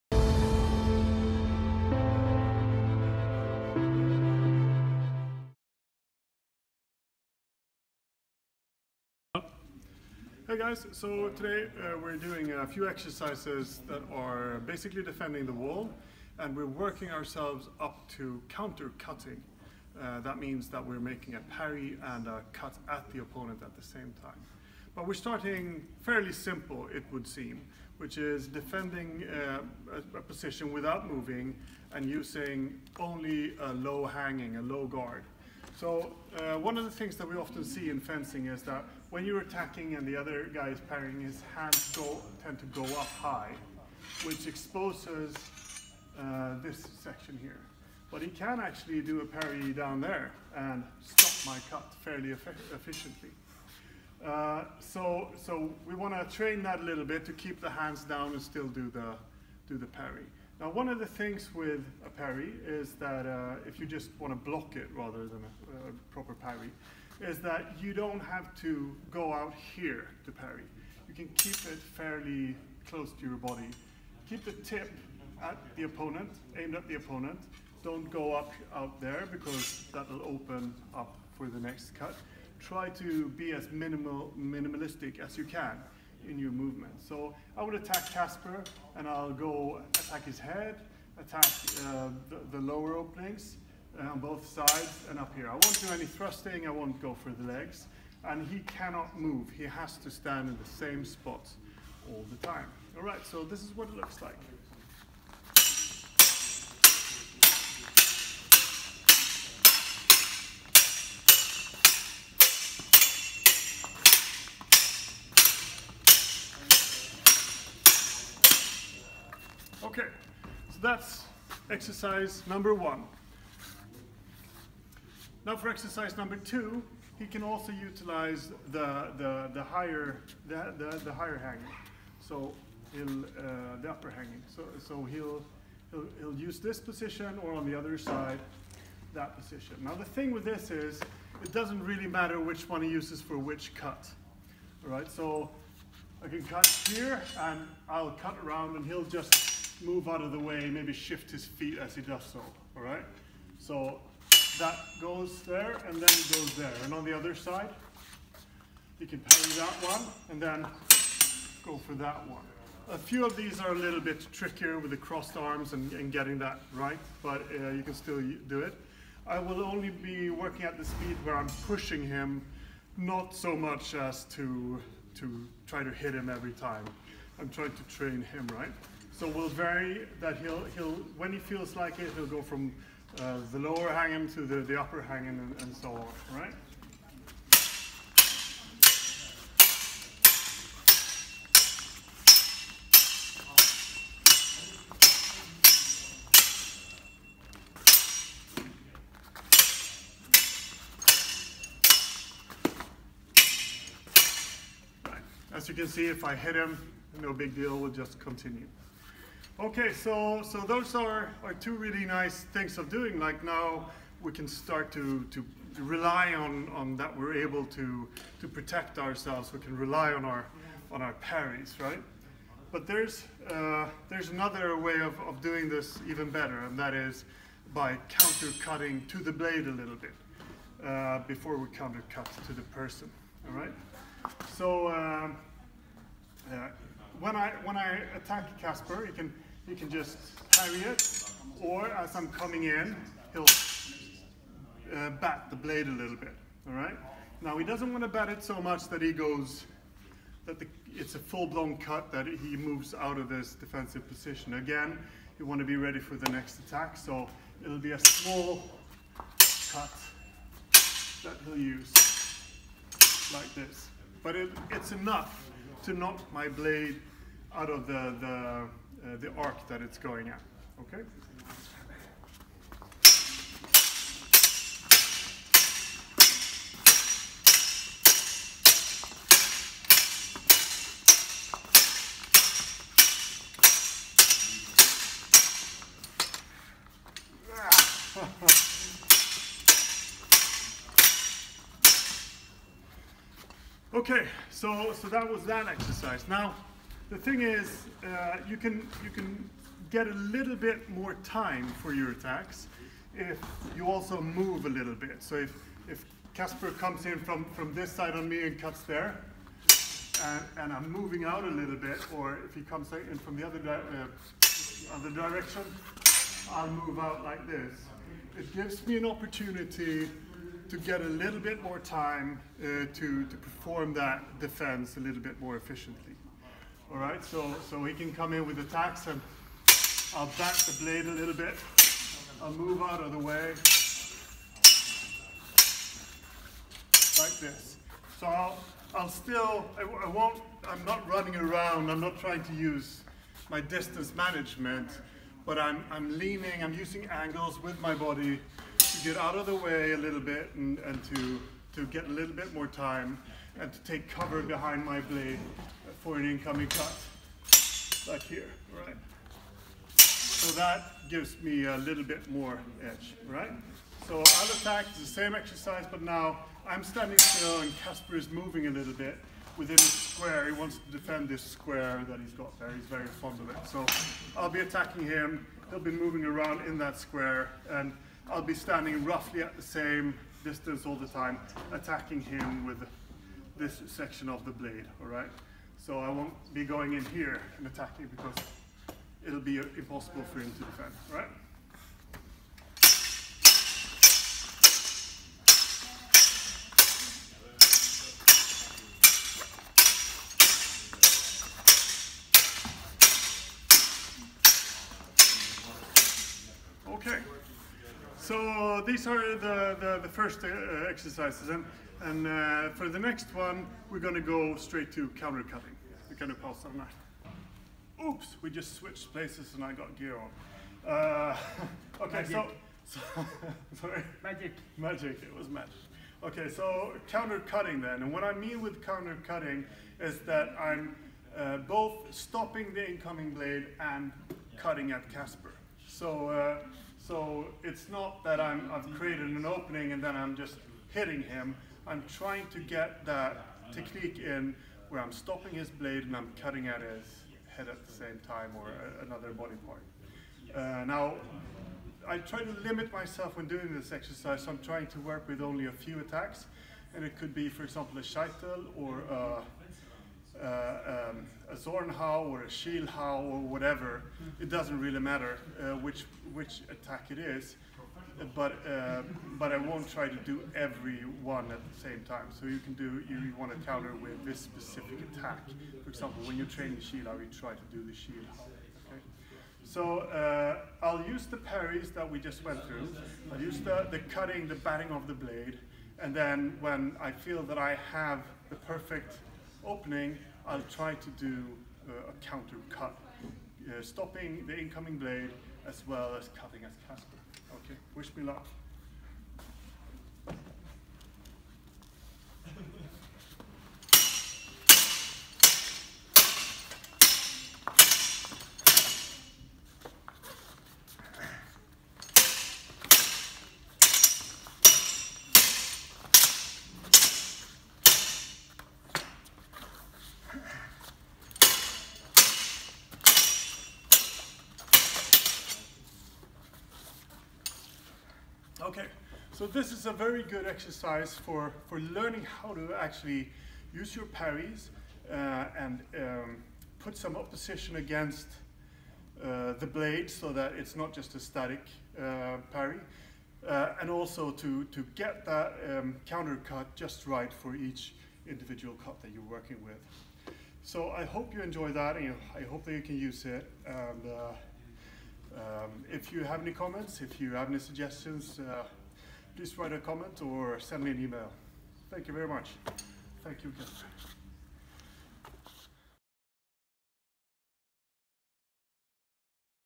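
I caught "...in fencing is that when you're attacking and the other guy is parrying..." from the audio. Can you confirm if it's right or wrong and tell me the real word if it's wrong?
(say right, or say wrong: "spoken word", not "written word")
right.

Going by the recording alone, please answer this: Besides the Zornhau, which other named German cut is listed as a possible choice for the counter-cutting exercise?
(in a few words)
Schielhau.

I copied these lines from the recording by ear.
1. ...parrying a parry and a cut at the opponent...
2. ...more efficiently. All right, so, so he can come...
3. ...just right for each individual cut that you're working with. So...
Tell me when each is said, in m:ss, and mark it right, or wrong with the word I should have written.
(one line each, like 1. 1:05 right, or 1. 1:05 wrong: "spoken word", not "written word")
1. 0:20 wrong: "making", not "parrying"
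2. 5:25 right
3. 9:06 right.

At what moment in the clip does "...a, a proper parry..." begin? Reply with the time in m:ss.
1:05.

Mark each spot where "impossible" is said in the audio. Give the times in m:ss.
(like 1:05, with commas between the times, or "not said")
6:29.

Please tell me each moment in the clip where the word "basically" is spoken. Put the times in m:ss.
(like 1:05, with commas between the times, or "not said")
0:14.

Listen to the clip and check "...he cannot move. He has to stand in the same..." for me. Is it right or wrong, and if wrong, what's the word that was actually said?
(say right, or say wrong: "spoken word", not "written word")
right.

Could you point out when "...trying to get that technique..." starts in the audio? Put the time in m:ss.
7:22.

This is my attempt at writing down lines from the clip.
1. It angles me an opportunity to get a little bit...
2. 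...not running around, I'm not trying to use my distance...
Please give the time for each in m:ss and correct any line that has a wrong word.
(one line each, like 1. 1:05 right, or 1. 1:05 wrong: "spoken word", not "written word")
1. 5:18 wrong: "gives", not "angles"
2. 5:40 right.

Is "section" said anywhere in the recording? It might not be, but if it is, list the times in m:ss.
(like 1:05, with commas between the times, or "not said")
0:47, 6:23.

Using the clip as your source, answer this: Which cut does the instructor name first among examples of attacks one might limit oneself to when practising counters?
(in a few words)
Scheitel.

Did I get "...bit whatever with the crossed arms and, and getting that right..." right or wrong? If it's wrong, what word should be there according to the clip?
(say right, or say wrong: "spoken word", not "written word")
wrong: "trickier", not "whatever".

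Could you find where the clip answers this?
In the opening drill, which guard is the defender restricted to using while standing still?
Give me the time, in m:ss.
0:33.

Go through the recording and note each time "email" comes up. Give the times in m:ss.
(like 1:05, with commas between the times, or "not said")
9:21.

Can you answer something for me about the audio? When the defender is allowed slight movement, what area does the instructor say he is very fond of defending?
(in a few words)
His square.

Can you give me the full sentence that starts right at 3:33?
Like now we can start to, to rely on, on that we're able to, to protect ourselves.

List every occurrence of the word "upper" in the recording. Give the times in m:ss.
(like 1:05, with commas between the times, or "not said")
2:13, 3:04.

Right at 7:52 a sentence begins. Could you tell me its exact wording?
So you can do you, you want to counter with this specific attack.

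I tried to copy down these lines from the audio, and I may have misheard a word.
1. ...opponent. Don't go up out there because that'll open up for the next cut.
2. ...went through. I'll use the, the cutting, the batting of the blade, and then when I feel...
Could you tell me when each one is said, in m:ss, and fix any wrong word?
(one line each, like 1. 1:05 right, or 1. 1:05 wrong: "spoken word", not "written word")
1. 1:16 right
2. 8:02 right.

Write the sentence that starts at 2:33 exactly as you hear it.
So that goes there and then it goes there.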